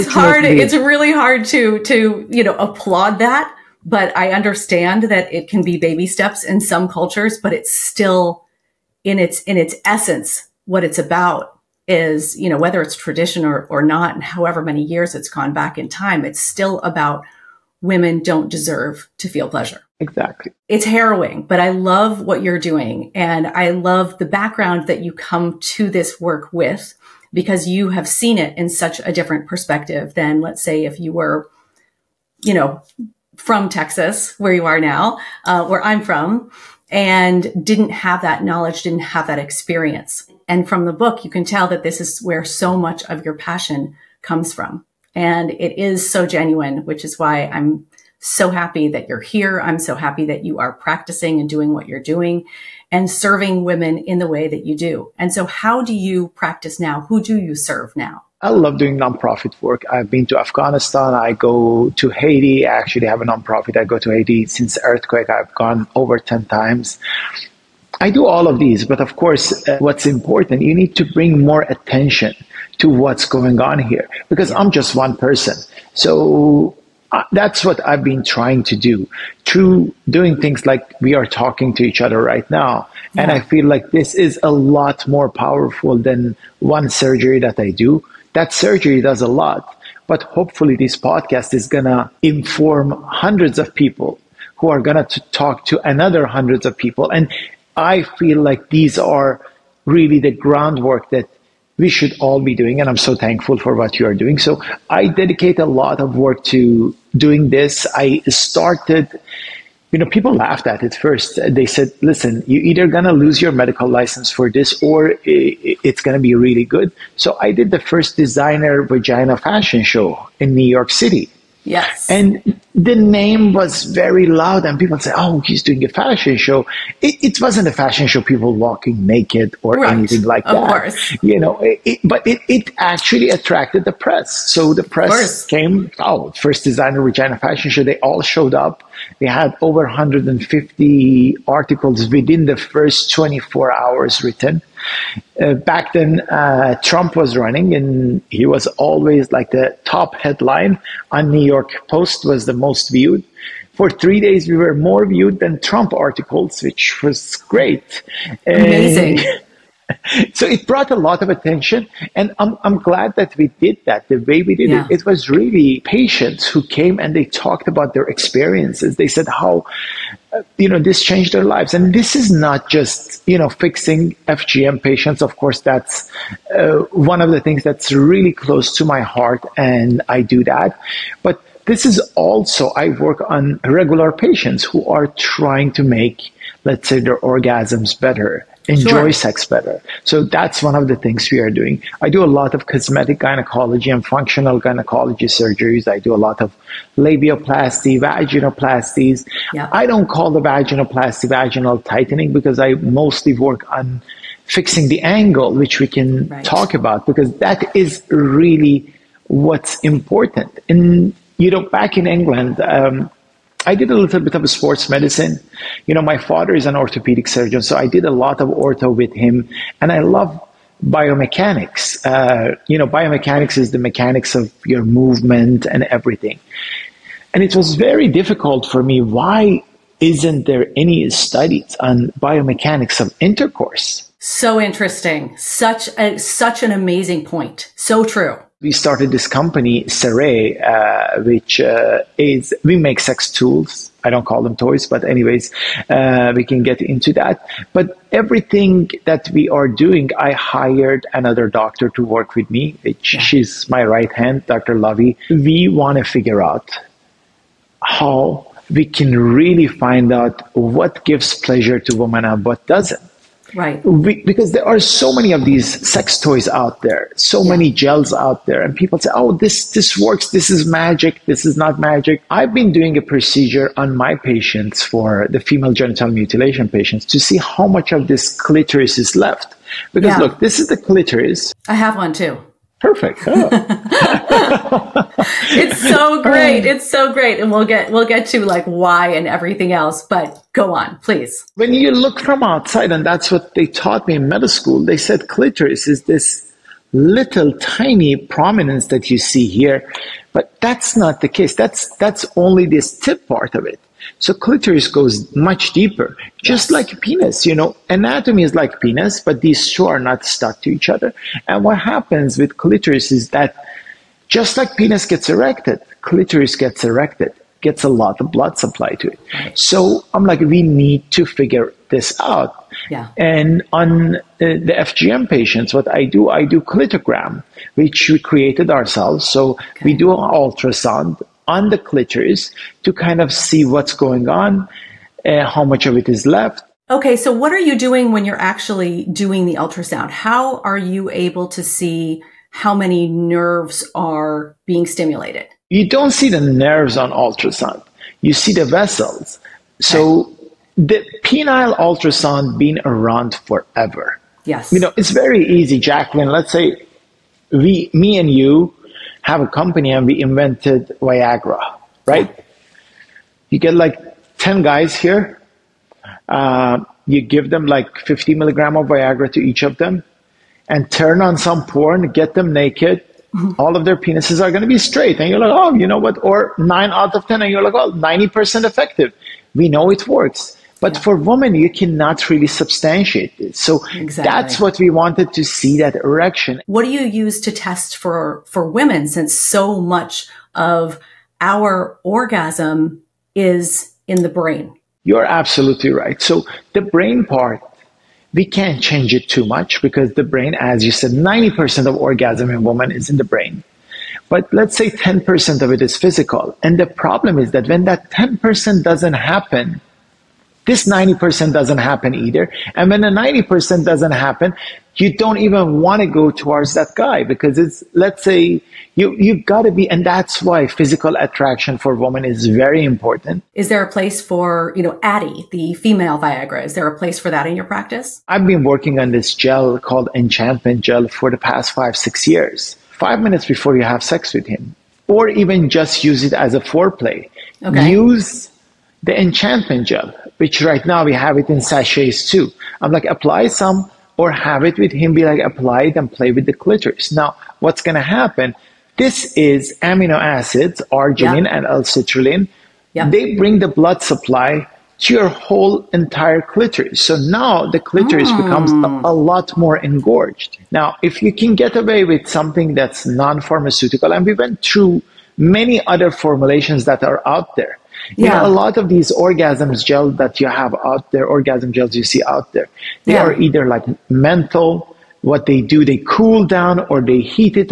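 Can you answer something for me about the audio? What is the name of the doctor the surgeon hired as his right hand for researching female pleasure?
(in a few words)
Dr. Lovey.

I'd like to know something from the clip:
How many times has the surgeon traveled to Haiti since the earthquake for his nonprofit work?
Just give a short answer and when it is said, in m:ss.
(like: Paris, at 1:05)
over 10, at 1:05.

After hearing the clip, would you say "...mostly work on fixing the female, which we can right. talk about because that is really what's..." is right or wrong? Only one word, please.
wrong.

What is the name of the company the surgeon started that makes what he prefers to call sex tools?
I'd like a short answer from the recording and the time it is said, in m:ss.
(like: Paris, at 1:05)
Cere, at 3:59.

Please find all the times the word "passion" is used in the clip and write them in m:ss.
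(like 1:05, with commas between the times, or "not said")
0:43.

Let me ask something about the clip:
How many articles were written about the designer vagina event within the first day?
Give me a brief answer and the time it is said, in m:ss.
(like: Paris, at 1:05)
over 150, at 2:19.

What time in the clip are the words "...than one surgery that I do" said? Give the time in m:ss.
1:25.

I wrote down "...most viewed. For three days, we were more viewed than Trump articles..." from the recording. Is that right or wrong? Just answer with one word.
right.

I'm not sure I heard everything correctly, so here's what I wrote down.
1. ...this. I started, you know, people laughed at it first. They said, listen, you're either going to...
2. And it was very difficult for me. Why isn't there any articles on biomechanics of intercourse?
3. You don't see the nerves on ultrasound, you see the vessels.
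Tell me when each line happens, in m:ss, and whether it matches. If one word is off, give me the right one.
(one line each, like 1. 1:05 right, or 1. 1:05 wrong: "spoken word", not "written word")
1. 1:47 right
2. 3:47 wrong: "studies", not "articles"
3. 5:45 right.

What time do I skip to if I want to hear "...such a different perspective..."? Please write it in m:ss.
0:28.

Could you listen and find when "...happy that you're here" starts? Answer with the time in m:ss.
0:48.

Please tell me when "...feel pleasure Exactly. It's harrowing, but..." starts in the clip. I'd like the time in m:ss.
0:19.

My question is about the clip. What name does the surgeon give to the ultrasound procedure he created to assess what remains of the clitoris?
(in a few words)
clitogram.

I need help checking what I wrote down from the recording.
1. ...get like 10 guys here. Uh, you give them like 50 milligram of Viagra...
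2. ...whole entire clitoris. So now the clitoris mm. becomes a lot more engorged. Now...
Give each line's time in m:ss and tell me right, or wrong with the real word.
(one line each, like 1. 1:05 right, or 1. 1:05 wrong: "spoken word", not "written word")
1. 6:03 right
2. 7:35 right.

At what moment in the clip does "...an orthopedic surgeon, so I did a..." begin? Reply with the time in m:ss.
3:36.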